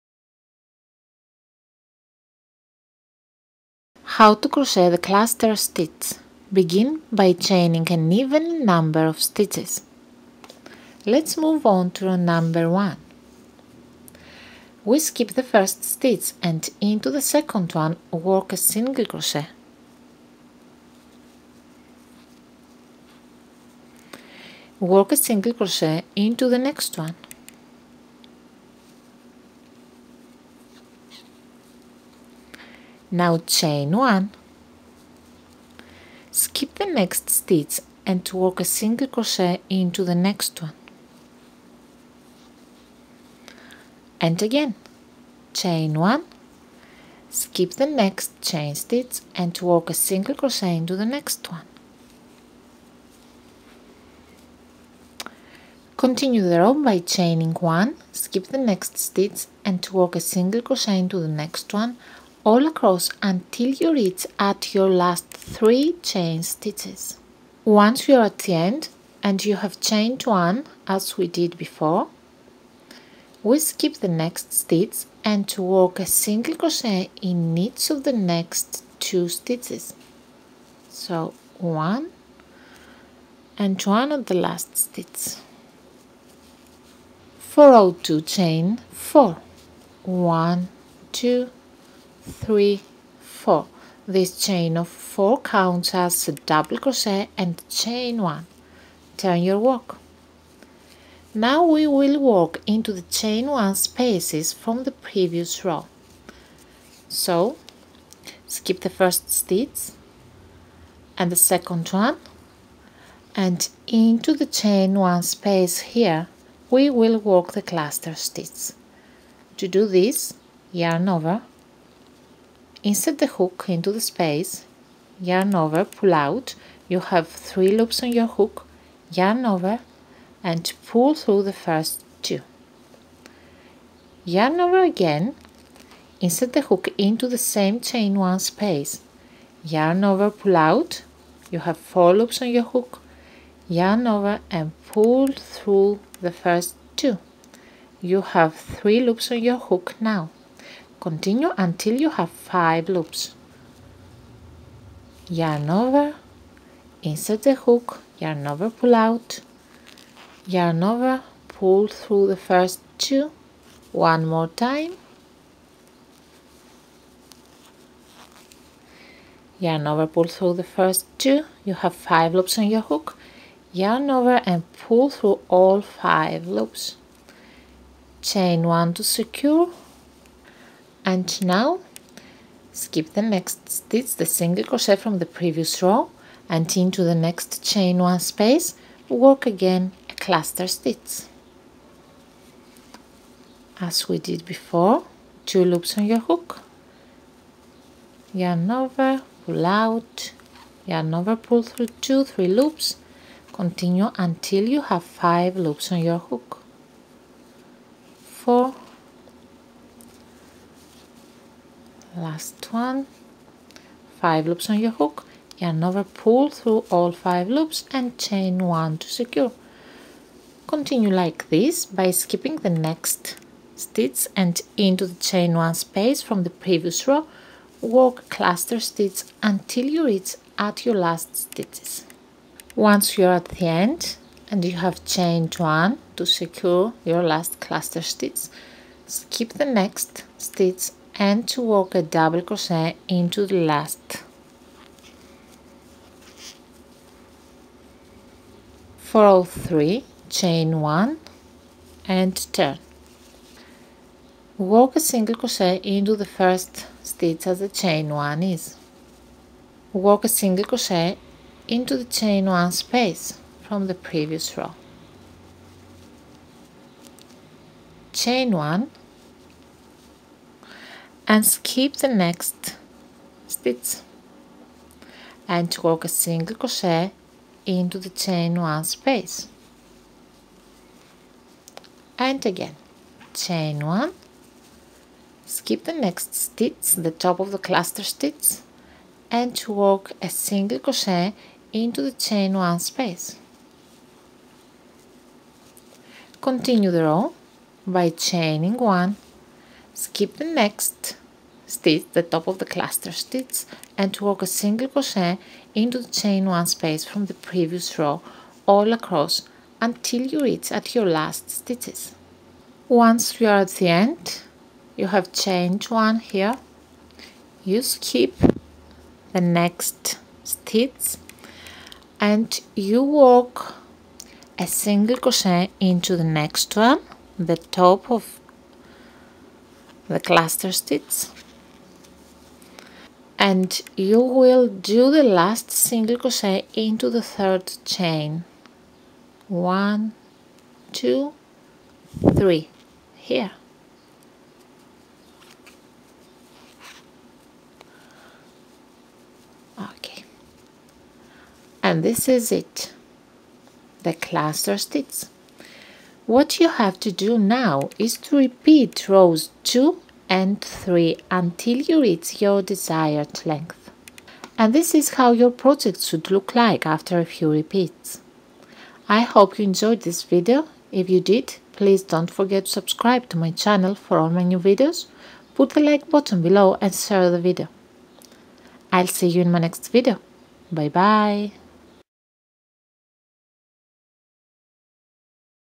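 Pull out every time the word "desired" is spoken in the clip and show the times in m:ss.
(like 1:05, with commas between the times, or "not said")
6:02.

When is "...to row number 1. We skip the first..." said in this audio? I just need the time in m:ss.
0:11.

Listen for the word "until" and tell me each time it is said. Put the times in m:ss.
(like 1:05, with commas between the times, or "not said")
1:03, 2:31, 3:24, 3:49, 5:09, 6:01.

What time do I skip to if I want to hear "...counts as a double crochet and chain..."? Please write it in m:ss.
1:35.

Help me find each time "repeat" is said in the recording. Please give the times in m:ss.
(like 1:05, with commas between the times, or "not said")
5:58, 6:07.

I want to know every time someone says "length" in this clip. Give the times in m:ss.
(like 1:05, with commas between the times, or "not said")
6:03.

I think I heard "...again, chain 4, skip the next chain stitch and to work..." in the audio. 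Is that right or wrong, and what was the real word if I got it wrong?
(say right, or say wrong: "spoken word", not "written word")
wrong: "1", not "4".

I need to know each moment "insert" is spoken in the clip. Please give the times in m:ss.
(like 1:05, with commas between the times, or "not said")
2:02, 2:16, 2:37.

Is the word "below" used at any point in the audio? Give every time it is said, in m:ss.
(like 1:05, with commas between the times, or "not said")
6:16.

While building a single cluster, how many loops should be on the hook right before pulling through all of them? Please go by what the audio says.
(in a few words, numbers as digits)
5.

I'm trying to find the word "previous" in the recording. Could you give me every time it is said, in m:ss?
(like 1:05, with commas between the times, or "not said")
1:44, 3:05, 3:46, 4:24, 5:07.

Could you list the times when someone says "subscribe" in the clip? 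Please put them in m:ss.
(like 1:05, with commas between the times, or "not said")
6:12.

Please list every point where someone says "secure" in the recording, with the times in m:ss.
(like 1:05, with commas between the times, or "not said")
2:59, 3:39, 3:56.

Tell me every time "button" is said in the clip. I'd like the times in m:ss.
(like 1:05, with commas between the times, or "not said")
6:16.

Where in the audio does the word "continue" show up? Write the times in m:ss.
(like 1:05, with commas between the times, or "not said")
0:55, 2:31, 3:23, 3:40, 4:56.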